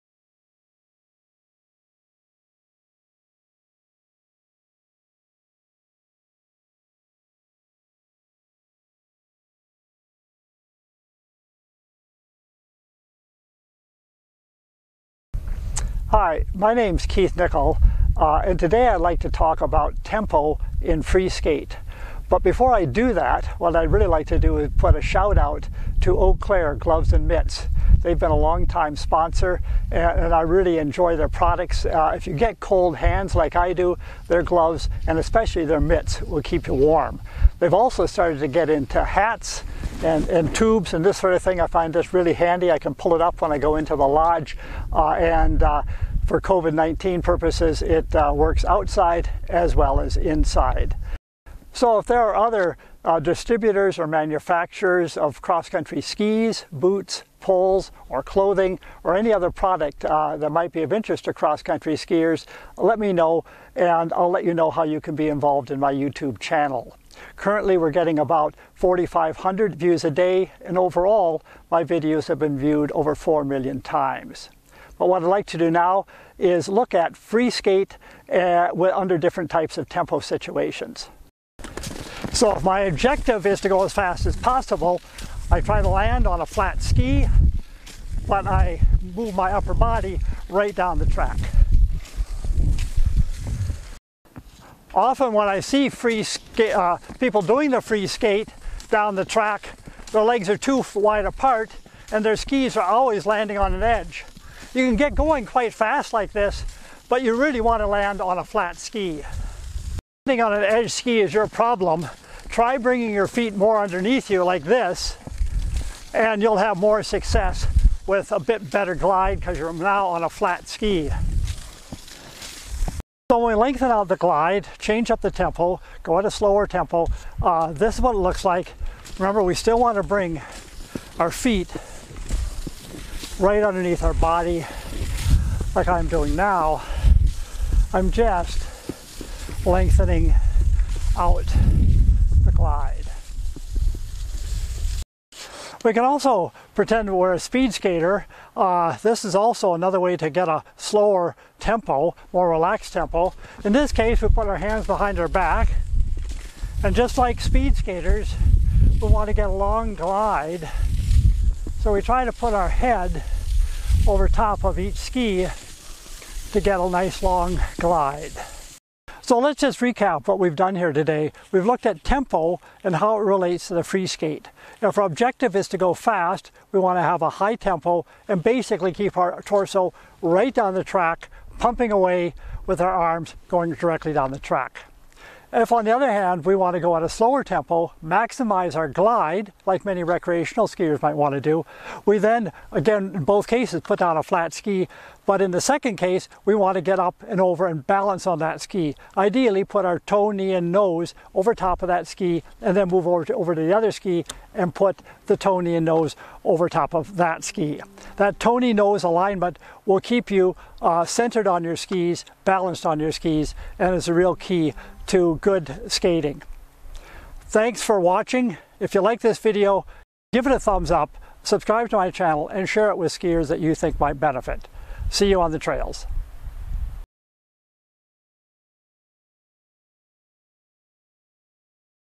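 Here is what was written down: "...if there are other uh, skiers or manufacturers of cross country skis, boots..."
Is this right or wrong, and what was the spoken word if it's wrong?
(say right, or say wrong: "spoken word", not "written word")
wrong: "distributors", not "skiers".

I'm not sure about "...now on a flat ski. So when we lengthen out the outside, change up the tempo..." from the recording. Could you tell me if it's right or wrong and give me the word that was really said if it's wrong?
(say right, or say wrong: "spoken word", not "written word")
wrong: "glide", not "outside".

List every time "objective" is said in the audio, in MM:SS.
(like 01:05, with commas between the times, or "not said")
01:22, 02:55.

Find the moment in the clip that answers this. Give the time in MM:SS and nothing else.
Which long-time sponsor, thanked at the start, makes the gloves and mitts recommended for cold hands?
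00:26.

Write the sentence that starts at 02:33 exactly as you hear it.
In this case, we put our hands behind our back.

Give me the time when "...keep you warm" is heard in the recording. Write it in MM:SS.
00:36.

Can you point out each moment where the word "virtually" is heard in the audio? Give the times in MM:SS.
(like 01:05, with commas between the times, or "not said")
not said.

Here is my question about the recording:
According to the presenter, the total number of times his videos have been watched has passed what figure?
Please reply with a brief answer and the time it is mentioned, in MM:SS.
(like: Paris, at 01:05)
4 million, at 01:13.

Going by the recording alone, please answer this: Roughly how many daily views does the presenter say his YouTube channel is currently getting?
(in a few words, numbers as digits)
4,500.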